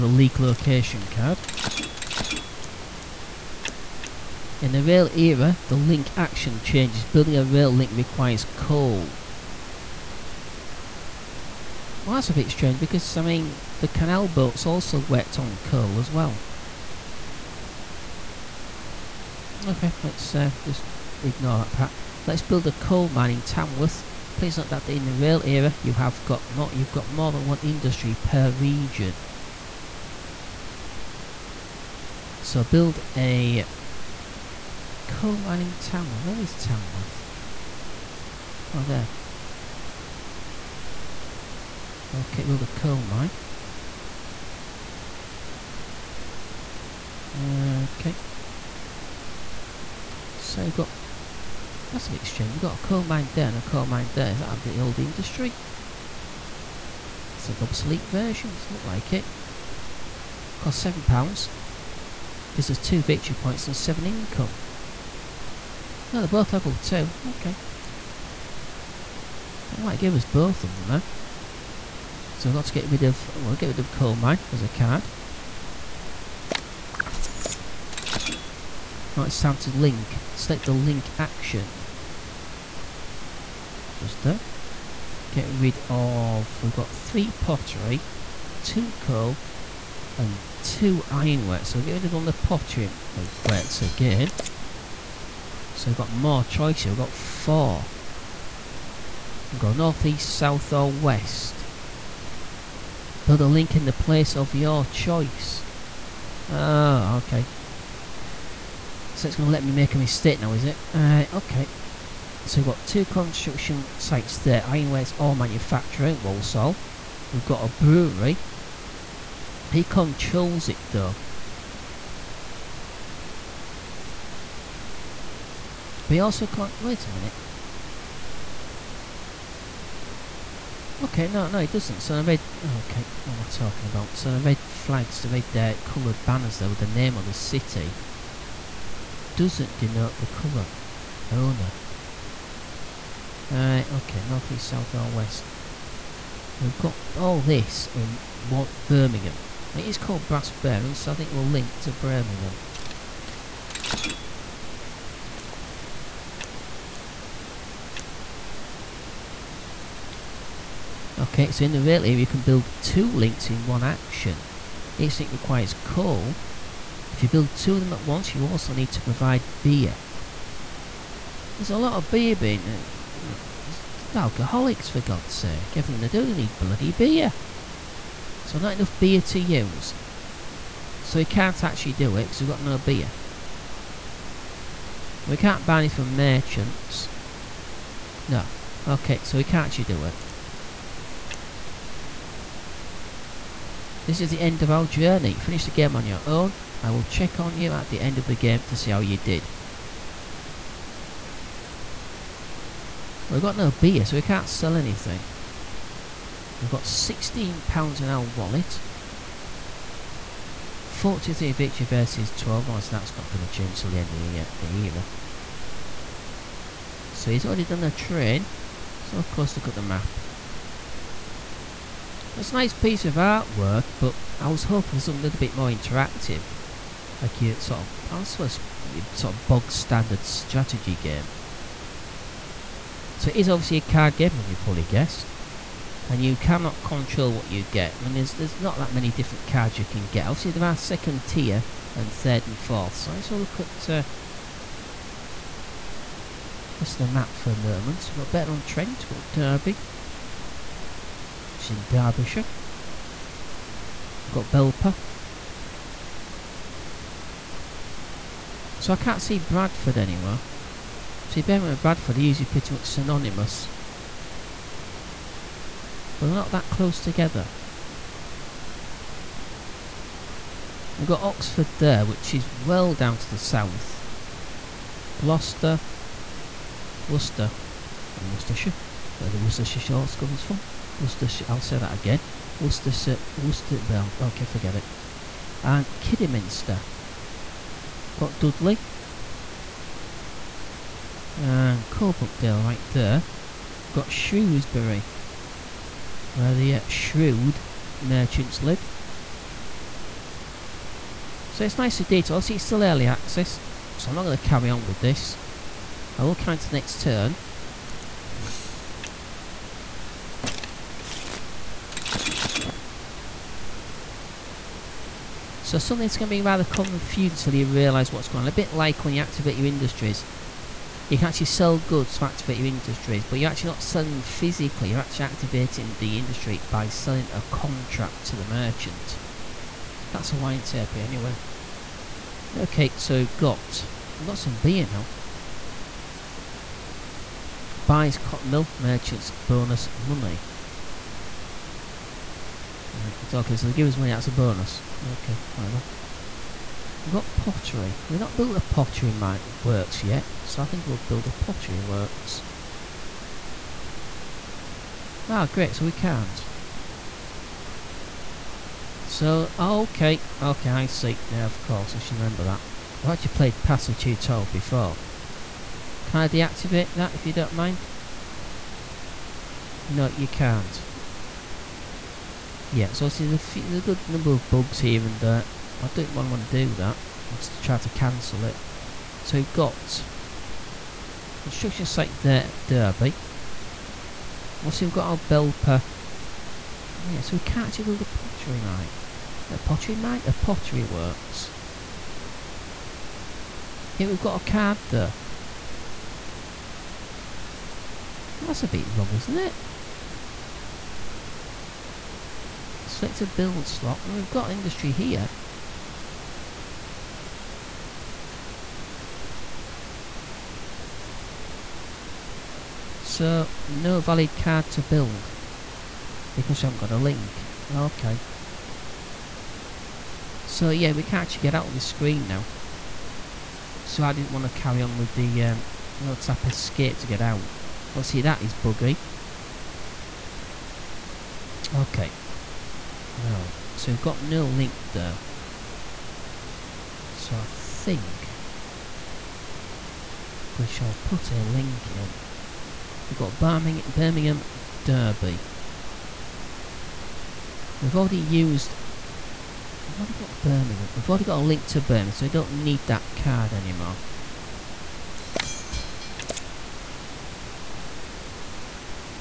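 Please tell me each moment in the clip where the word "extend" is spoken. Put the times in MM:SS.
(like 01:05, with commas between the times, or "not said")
not said.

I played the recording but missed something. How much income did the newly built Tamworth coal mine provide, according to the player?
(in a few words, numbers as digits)
7.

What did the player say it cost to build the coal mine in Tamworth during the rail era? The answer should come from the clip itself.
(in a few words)
£7.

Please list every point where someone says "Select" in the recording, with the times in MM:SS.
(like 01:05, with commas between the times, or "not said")
01:20, 06:42.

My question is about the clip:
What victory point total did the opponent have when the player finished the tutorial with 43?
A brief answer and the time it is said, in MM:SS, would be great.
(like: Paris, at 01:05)
12, at 03:32.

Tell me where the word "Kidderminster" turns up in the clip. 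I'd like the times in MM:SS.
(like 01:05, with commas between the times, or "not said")
04:45.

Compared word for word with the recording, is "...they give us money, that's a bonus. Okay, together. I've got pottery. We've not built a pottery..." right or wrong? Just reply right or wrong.
wrong.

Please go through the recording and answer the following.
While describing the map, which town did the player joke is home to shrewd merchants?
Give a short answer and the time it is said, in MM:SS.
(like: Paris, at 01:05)
Shrewsbury, at 04:54.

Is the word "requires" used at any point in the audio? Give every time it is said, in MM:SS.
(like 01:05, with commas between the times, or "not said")
00:07, 02:45.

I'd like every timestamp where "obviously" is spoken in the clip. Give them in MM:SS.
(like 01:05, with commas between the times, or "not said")
03:32, 03:53, 04:00.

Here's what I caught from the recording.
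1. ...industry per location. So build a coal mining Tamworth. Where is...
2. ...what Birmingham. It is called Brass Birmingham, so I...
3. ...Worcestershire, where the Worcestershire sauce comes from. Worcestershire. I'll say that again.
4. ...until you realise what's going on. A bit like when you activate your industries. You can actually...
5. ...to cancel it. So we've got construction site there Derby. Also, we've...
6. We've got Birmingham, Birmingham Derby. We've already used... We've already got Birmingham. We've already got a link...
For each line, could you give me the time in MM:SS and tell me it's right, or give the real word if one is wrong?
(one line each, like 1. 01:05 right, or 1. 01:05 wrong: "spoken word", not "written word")
1. 00:27 wrong: "region", not "location"
2. 02:28 right
3. 04:38 right
4. 05:17 right
5. 06:17 right
6. 07:23 right.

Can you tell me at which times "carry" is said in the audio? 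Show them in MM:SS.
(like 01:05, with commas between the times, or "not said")
05:04, 07:04.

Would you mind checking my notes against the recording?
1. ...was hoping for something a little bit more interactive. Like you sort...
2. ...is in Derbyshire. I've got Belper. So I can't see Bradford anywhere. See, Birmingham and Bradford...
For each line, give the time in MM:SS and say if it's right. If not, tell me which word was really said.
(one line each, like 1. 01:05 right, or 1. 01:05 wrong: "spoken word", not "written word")
1. 03:44 right
2. 04:11 right.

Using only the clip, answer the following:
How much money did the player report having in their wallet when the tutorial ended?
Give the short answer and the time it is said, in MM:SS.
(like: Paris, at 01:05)
£16, at 03:26.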